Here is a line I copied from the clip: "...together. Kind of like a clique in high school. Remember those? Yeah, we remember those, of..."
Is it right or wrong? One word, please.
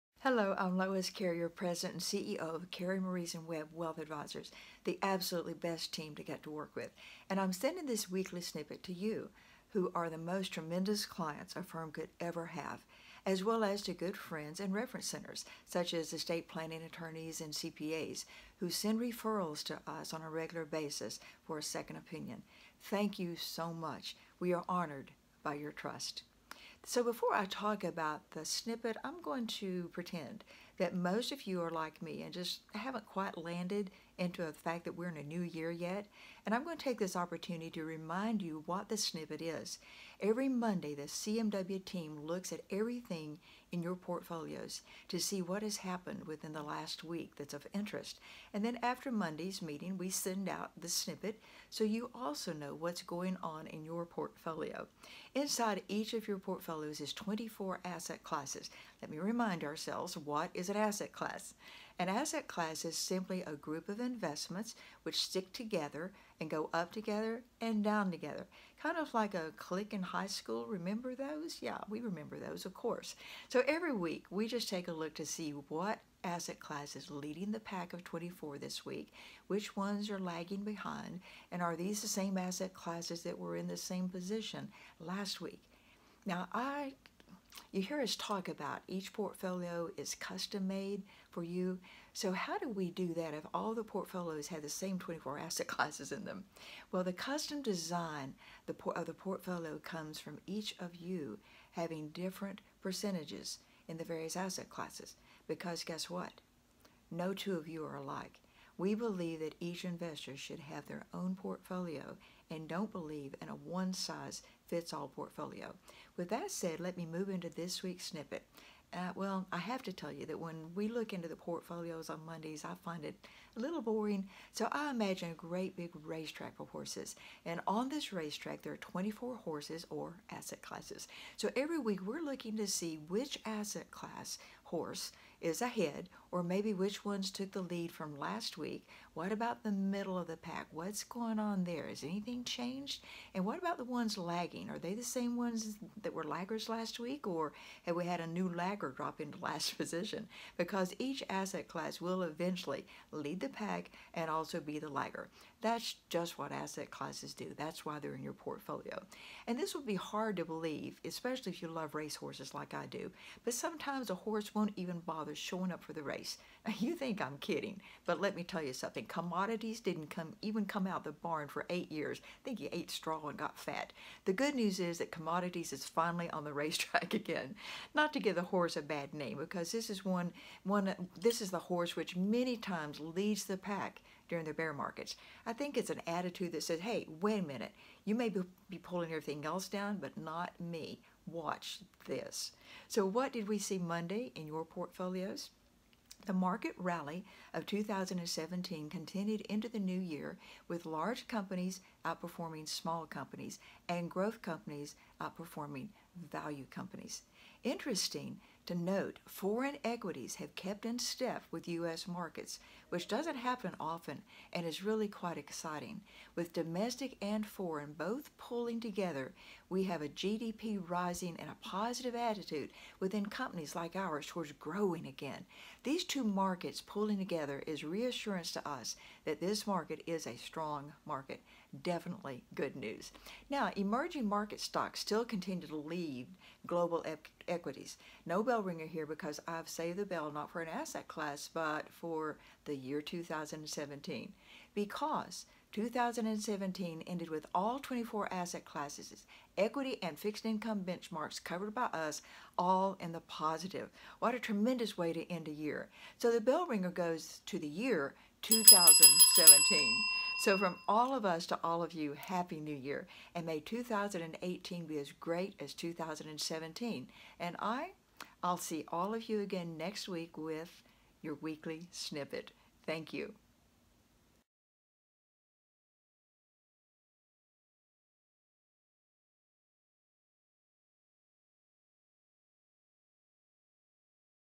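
right.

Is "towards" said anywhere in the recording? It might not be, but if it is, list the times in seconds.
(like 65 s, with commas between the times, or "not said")
224 s.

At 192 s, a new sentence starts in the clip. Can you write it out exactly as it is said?
So what did we see Monday in your portfolios?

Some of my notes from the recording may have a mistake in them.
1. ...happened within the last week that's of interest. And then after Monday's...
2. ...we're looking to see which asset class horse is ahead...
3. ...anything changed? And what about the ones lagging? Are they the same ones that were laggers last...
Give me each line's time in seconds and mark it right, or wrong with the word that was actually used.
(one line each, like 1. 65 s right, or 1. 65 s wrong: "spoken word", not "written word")
1. 45 s right
2. 132 s right
3. 142 s right.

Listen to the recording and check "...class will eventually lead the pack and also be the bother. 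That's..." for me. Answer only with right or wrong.
wrong.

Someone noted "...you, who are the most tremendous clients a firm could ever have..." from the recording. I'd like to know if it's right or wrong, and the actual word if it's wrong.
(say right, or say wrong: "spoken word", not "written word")
right.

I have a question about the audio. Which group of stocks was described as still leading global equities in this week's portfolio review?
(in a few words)
Emerging market stocks.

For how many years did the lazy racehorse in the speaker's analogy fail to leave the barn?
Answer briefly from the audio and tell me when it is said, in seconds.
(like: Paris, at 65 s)
8, at 171 s.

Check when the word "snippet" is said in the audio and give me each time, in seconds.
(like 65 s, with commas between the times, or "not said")
8 s, 28 s, 38 s, 50 s, 118 s, 271 s.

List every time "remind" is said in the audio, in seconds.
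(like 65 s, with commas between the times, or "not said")
37 s, 59 s.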